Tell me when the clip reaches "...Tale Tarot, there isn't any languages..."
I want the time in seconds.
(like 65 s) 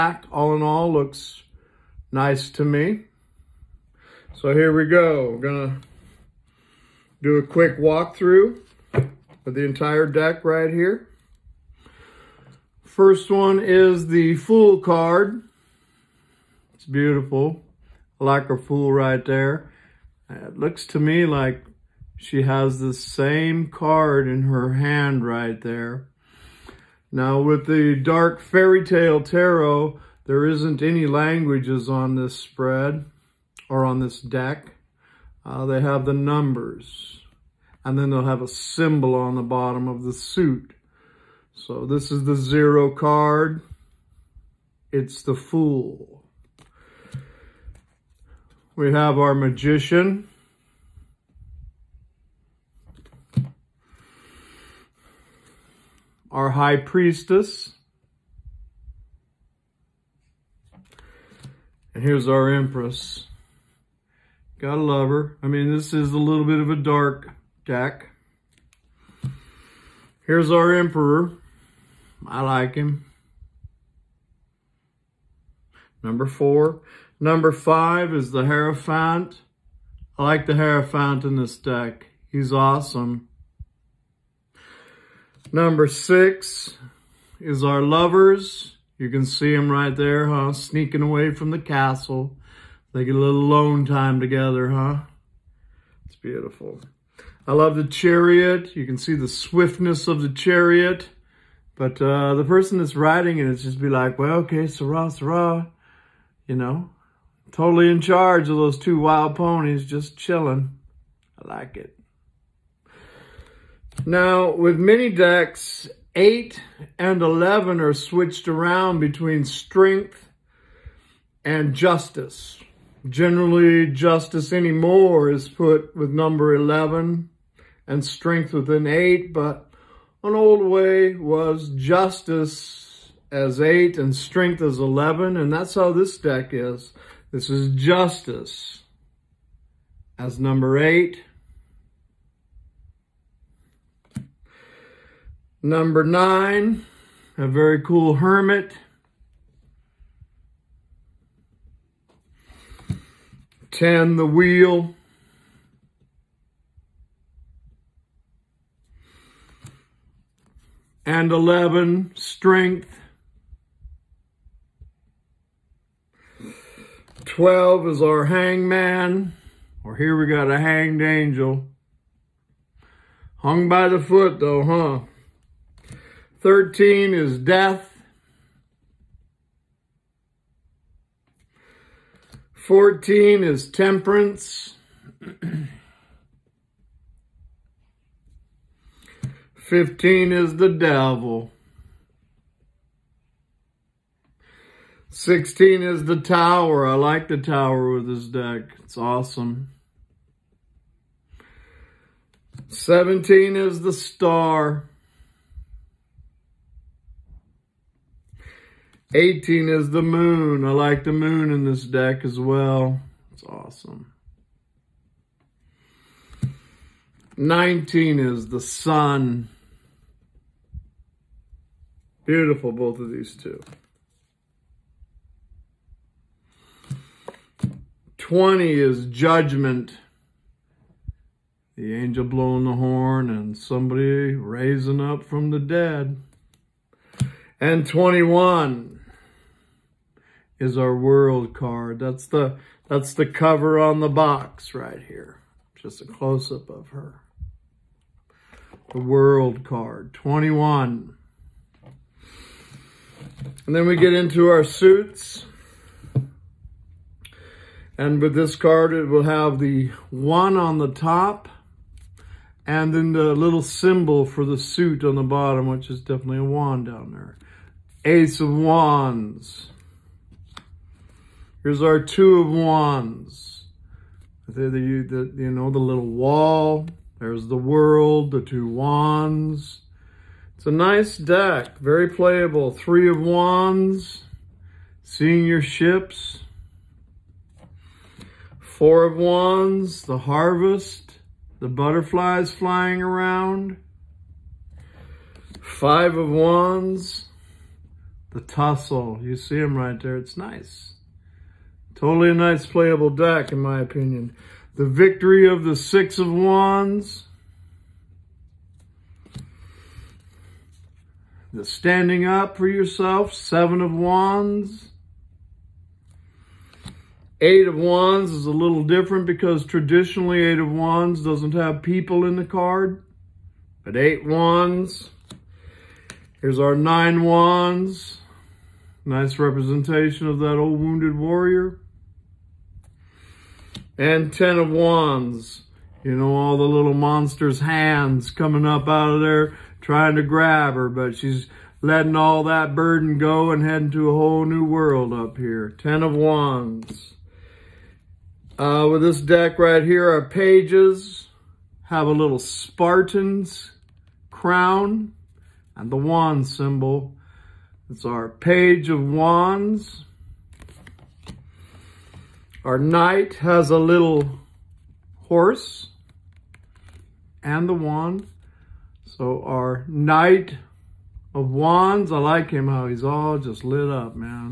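28 s.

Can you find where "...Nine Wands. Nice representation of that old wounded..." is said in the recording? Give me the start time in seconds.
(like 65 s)
326 s.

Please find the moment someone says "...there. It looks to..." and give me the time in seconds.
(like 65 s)
19 s.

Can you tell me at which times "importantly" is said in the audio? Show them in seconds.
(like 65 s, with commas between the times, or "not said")
not said.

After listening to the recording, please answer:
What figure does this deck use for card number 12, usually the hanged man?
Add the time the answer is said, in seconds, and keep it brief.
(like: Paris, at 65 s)
a hanged angel, at 170 s.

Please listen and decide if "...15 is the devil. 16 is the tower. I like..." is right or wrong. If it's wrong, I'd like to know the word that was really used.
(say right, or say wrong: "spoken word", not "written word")
right.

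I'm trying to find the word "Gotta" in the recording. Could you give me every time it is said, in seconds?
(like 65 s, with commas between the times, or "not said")
64 s.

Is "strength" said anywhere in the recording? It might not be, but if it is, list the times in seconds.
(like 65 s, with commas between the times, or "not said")
119 s, 128 s, 134 s, 162 s.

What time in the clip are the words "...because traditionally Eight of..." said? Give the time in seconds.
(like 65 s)
319 s.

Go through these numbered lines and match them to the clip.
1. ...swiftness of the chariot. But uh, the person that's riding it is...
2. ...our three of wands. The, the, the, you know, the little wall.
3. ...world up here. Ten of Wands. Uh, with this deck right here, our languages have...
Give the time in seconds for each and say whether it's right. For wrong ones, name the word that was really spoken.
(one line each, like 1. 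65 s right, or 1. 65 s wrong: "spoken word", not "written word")
1. 99 s right
2. 271 s wrong: "two", not "three"
3. 344 s wrong: "pages", not "languages".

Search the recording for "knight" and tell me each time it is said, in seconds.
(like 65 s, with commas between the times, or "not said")
362 s, 369 s.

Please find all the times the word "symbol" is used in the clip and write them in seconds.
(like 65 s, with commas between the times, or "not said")
38 s, 263 s, 356 s.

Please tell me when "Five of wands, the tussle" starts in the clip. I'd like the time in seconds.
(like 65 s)
295 s.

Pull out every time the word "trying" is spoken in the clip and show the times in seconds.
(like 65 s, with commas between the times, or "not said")
339 s.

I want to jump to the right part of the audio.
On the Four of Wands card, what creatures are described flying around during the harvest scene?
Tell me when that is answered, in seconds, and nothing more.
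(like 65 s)
291 s.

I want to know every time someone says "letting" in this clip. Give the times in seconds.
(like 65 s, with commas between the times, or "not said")
341 s.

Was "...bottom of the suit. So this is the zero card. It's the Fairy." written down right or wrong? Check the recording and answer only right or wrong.
wrong.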